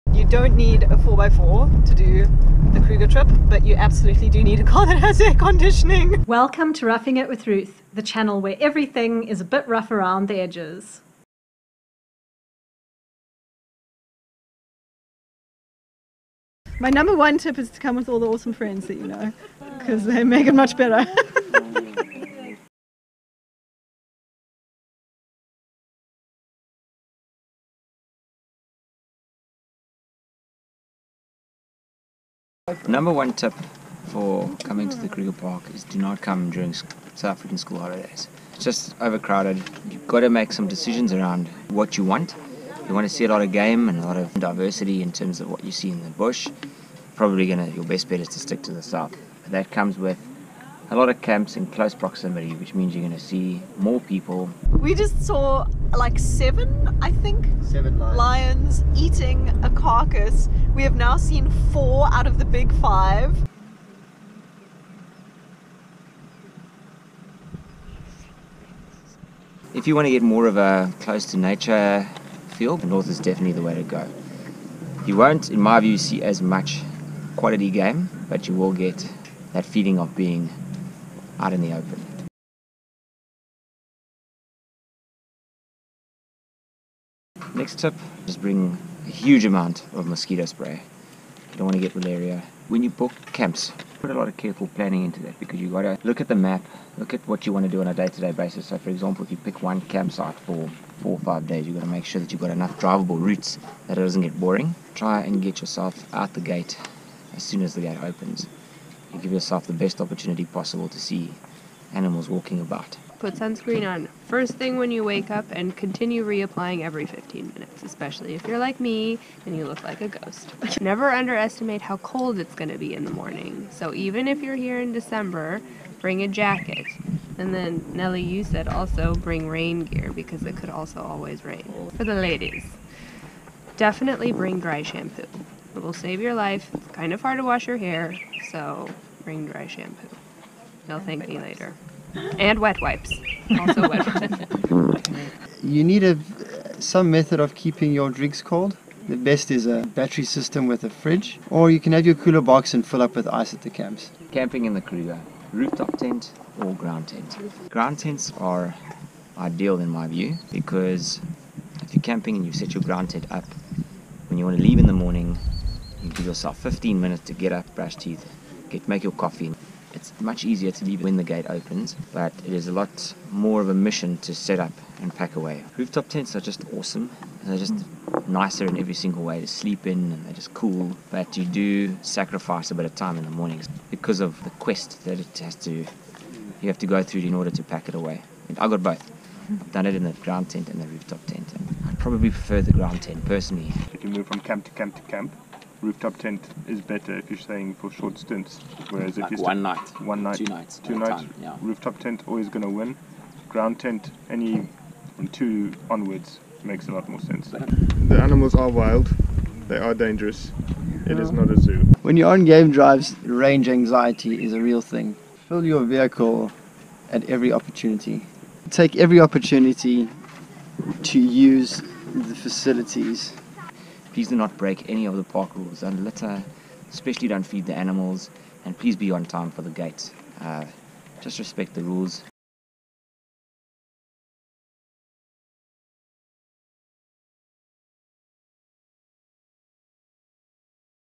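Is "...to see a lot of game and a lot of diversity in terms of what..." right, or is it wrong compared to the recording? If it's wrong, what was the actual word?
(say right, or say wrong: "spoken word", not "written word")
right.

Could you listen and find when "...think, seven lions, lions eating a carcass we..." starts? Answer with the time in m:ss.
0:57.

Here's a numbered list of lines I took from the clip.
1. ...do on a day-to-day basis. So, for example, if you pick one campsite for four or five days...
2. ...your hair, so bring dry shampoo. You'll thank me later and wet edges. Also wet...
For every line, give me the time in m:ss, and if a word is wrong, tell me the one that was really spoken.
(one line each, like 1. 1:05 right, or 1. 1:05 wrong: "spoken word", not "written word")
1. 1:37 right
2. 2:17 wrong: "wipes", not "edges".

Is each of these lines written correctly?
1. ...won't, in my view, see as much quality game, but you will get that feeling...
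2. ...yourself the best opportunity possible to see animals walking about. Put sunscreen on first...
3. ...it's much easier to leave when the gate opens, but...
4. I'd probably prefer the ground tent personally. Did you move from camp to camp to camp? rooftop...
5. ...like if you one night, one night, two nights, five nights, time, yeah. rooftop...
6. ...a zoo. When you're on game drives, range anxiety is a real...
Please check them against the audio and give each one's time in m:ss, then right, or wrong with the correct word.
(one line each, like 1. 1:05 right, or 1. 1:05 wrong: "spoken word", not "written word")
1. 1:15 right
2. 1:49 right
3. 2:50 right
4. 3:11 right
5. 3:19 wrong: "two", not "five"
6. 3:31 right.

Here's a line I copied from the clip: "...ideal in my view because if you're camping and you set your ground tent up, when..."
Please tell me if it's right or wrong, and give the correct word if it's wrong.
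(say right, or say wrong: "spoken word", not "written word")
right.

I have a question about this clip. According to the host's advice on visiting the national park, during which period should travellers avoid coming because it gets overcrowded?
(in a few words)
South African school holidays.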